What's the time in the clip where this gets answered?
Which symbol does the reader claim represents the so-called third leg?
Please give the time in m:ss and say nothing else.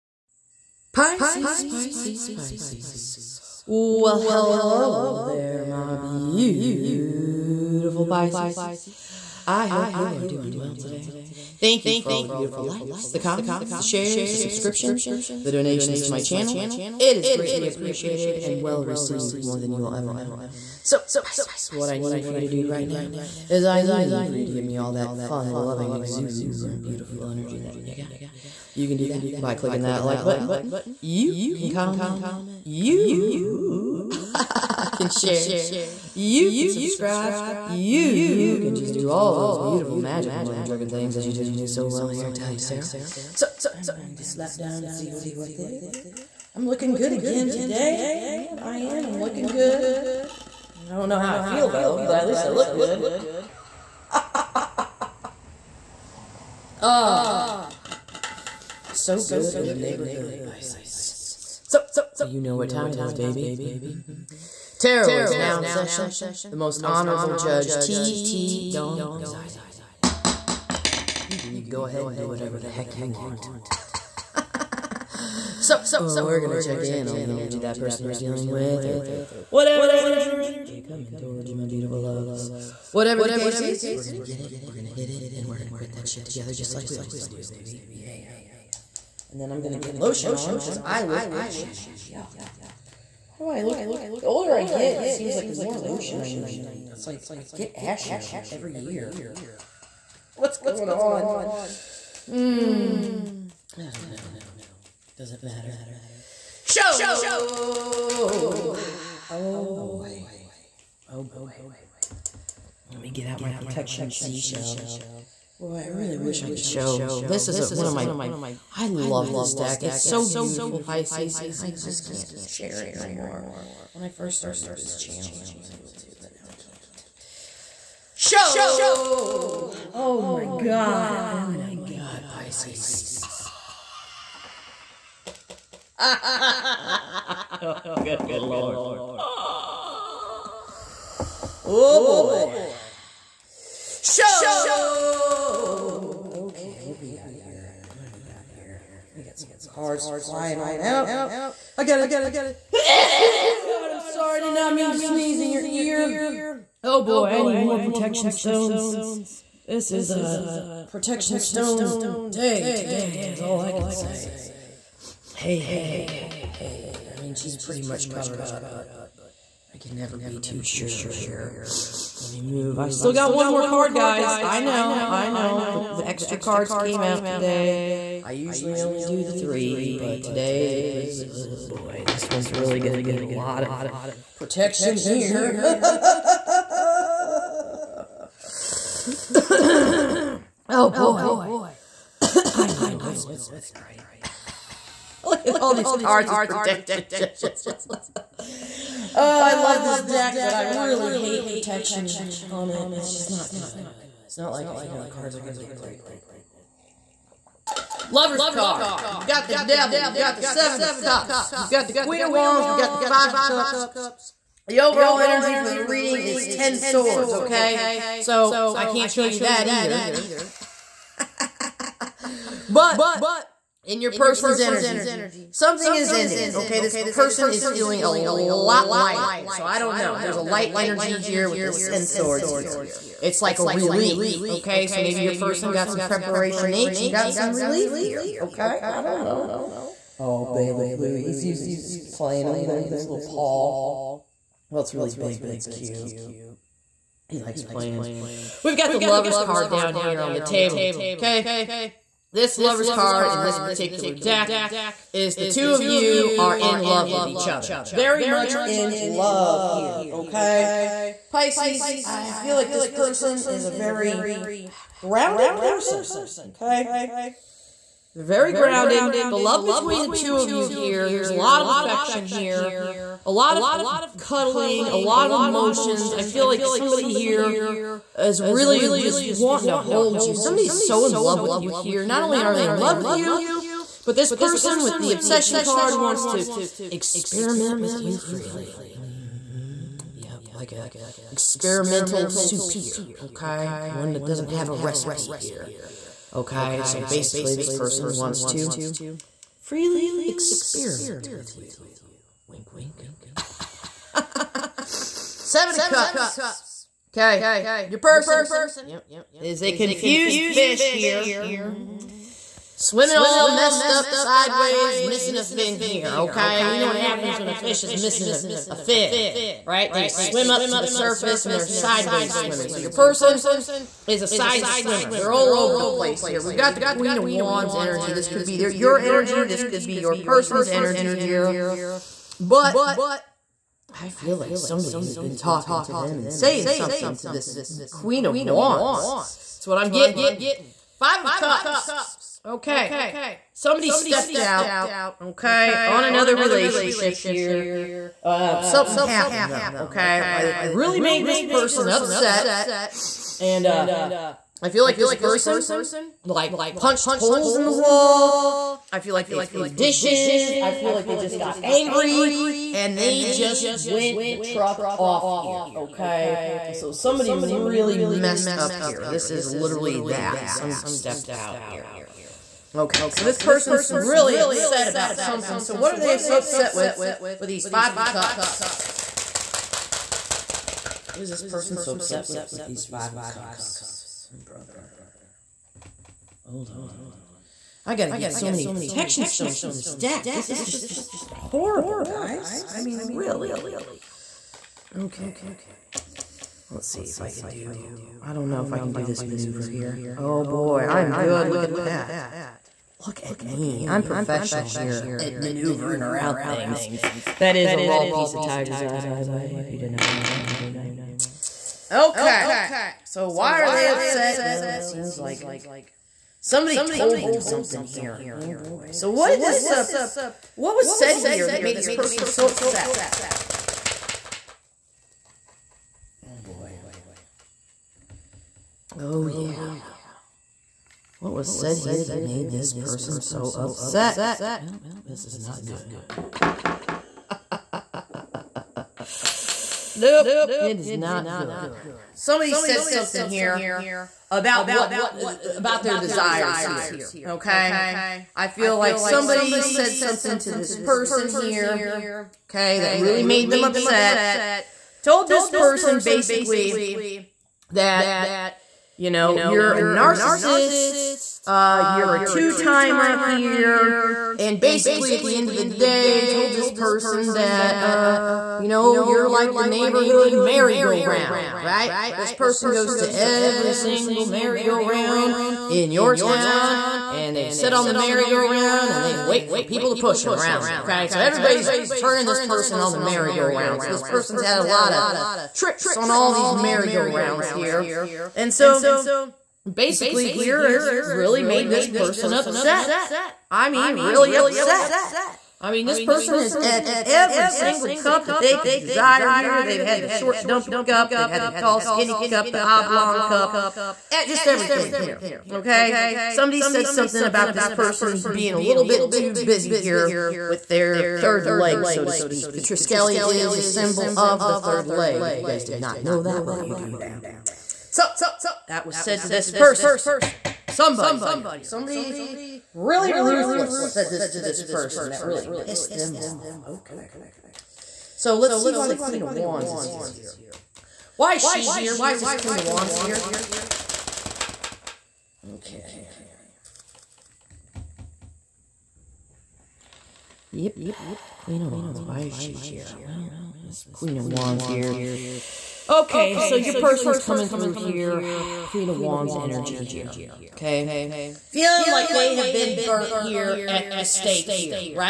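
8:32.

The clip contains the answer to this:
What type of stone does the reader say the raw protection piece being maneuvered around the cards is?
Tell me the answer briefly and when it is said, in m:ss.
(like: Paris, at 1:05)
tiger's eye, at 6:48.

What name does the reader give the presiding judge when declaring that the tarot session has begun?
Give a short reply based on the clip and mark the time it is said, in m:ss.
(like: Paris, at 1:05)
T. T. Dong, at 1:07.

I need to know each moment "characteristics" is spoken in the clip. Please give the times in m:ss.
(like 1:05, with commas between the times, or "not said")
not said.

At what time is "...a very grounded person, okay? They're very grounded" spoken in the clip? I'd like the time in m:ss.
4:23.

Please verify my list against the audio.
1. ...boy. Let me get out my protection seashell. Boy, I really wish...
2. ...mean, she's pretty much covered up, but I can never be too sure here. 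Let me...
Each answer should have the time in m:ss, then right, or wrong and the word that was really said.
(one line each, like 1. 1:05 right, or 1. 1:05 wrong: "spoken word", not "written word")
1. 1:51 right
2. 2:47 right.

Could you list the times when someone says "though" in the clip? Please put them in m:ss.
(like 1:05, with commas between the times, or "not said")
0:51, 5:49.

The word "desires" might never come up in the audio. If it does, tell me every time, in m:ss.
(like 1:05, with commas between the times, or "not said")
7:25, 8:18.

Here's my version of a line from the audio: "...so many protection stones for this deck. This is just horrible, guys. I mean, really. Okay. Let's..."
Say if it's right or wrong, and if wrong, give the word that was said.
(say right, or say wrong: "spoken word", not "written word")
right.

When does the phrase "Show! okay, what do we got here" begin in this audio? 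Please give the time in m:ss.
2:24.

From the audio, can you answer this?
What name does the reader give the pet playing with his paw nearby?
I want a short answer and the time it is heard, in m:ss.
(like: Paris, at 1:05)
Bailiff Louie, at 4:00.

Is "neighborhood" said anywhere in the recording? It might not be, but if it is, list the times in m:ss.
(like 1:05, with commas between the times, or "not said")
0:59, 7:49.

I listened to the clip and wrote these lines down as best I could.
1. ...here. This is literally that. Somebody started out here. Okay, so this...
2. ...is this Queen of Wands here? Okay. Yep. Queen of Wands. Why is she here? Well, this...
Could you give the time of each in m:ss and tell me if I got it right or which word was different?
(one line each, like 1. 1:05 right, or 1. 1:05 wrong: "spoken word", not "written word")
1. 6:08 wrong: "stepped", not "started"
2. 8:52 right.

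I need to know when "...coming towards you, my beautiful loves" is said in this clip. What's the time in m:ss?
1:20.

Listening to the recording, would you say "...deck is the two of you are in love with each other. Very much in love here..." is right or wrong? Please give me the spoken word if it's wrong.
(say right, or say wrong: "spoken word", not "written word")
right.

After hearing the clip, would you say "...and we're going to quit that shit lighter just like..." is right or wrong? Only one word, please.
wrong.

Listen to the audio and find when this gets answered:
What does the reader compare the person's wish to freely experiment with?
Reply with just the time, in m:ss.
4:51.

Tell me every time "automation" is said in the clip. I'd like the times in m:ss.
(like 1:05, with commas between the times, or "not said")
not said.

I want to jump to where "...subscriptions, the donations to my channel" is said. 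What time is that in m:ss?
0:14.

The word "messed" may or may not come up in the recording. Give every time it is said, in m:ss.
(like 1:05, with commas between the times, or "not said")
5:13, 6:07.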